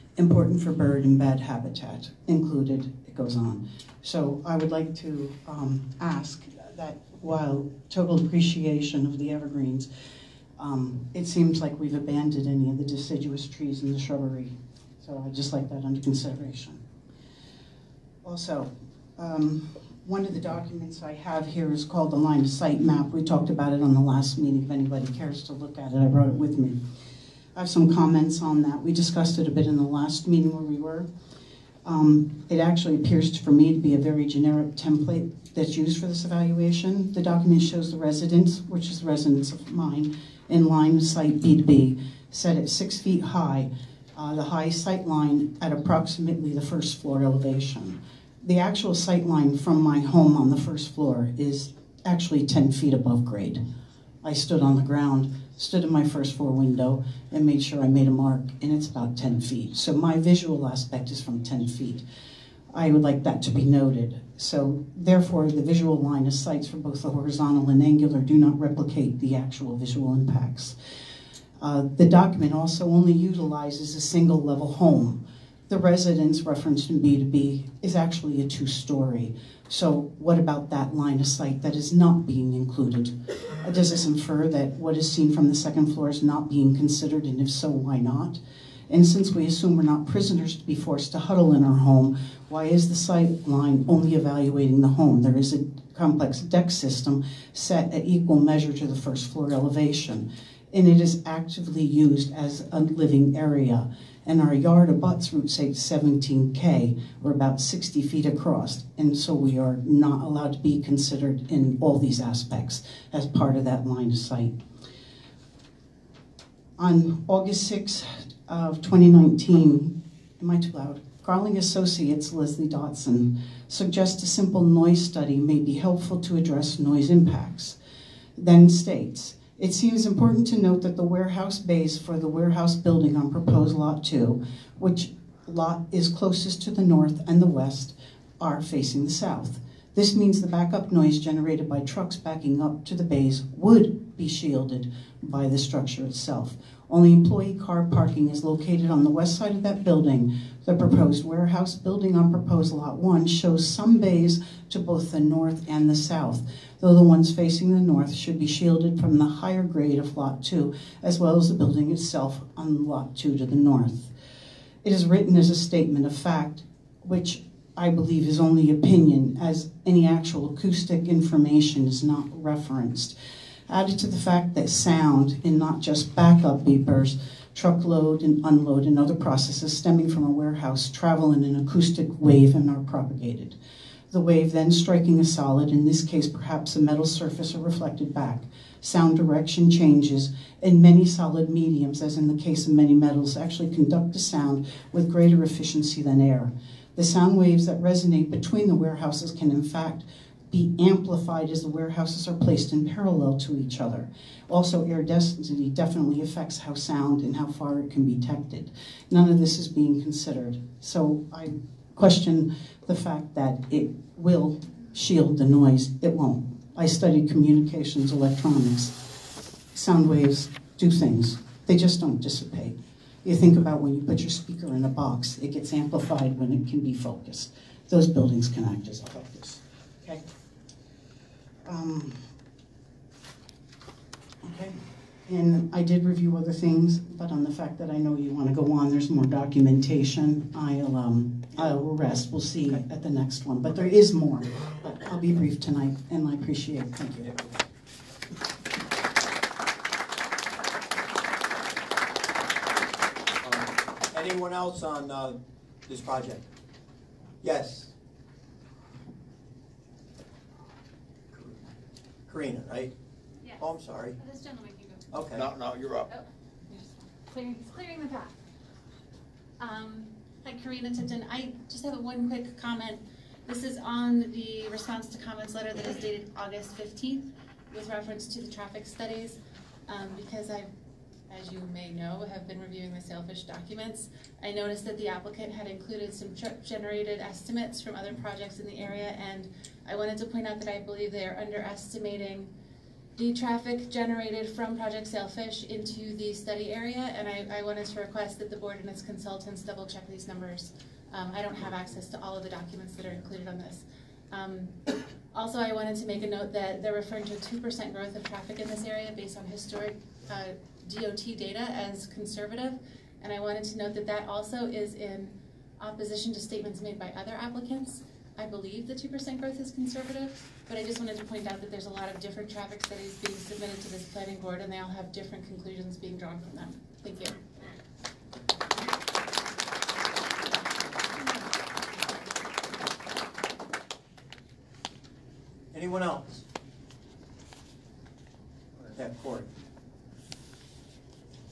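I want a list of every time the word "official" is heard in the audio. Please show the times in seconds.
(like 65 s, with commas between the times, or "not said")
not said.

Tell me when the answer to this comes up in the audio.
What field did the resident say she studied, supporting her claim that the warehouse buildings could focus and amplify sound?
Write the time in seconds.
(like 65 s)
217 s.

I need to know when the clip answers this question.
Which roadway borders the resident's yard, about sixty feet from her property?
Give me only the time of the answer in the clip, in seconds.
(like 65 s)
105 s.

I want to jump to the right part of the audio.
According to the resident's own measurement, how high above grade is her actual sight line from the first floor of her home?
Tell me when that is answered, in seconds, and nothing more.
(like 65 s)
52 s.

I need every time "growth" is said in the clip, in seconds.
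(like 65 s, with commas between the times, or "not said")
307 s, 319 s.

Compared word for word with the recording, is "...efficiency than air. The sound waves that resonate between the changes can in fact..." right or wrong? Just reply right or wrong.
wrong.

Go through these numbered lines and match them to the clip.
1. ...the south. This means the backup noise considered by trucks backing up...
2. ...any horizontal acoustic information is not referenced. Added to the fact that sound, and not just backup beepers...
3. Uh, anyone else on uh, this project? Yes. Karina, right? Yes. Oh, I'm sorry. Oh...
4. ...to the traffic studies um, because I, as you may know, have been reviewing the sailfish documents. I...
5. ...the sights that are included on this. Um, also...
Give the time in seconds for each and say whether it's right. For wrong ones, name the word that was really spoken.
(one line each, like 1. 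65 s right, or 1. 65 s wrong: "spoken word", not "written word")
1. 139 s wrong: "generated", not "considered"
2. 169 s wrong: "actual", not "horizontal"
3. 253 s right
4. 278 s right
5. 302 s wrong: "documents", not "sights".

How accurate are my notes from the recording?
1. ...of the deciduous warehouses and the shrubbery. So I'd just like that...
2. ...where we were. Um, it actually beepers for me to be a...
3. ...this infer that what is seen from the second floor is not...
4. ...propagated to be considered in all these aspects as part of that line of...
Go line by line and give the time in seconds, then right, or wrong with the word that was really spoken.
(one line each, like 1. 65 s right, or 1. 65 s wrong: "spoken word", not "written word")
1. 12 s wrong: "trees", not "warehouses"
2. 30 s wrong: "appears", not "beepers"
3. 83 s right
4. 110 s wrong: "allowed", not "propagated".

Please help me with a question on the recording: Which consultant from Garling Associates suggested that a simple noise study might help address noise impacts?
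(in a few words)
Leslie Dotson.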